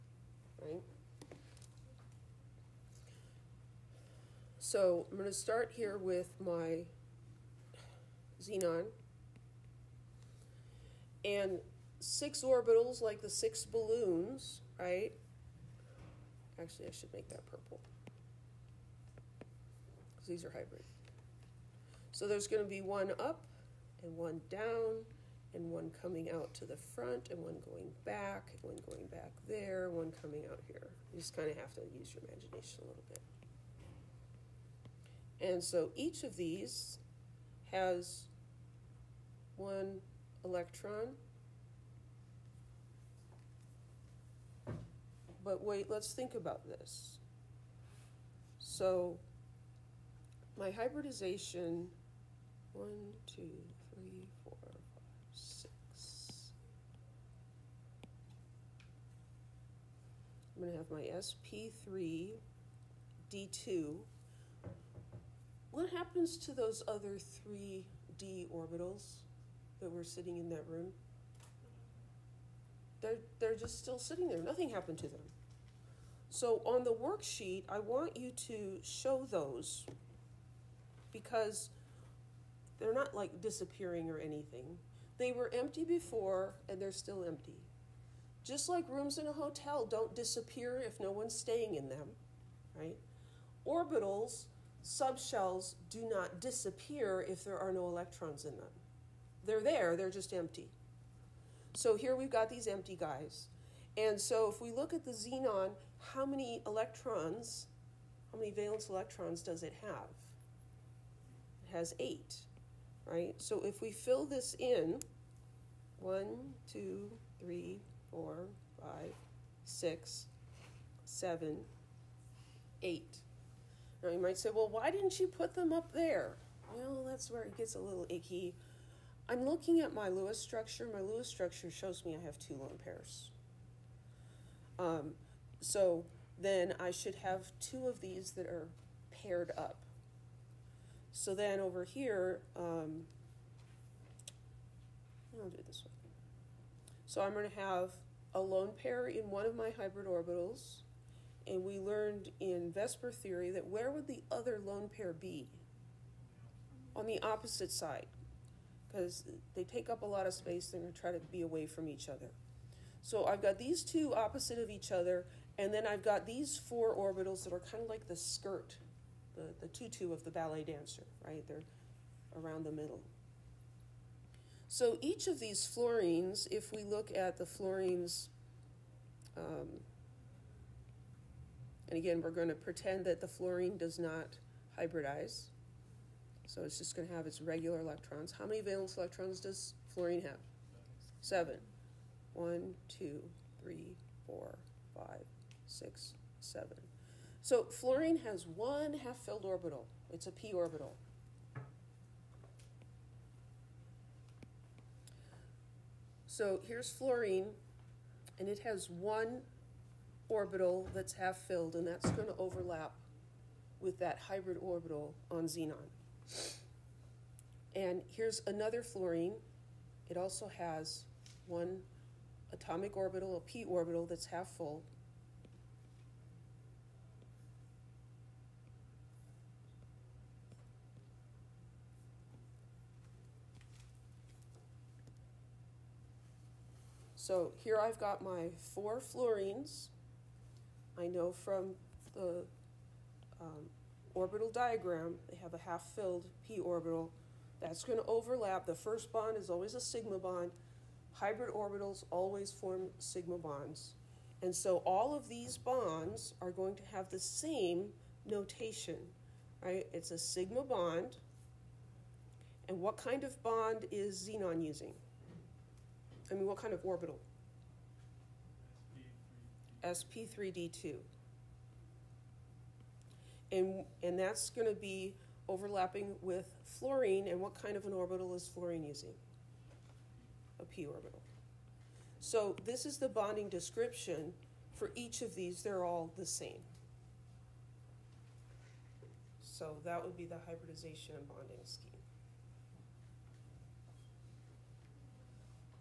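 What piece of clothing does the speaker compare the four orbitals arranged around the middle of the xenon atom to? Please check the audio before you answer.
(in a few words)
Tutu.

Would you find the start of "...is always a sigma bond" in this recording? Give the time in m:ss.
4:09.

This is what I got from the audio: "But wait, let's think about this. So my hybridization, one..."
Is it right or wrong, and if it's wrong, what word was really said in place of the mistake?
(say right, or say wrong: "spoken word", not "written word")
right.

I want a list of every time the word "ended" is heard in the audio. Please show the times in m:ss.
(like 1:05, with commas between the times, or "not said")
not said.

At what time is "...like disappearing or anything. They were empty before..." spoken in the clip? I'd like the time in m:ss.
1:23.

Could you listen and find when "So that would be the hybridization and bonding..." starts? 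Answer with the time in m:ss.
4:49.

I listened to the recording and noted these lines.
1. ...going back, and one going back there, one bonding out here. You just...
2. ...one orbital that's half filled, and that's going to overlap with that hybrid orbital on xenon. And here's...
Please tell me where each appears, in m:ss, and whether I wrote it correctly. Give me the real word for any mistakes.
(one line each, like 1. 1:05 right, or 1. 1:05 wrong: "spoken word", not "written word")
1. 0:27 wrong: "coming", not "bonding"
2. 3:28 right.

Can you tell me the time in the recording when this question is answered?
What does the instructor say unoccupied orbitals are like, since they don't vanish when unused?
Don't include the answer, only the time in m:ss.
1:28.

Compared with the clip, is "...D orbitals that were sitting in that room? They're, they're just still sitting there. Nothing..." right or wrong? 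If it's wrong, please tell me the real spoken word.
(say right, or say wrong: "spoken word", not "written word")
right.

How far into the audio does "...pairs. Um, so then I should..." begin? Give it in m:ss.
2:12.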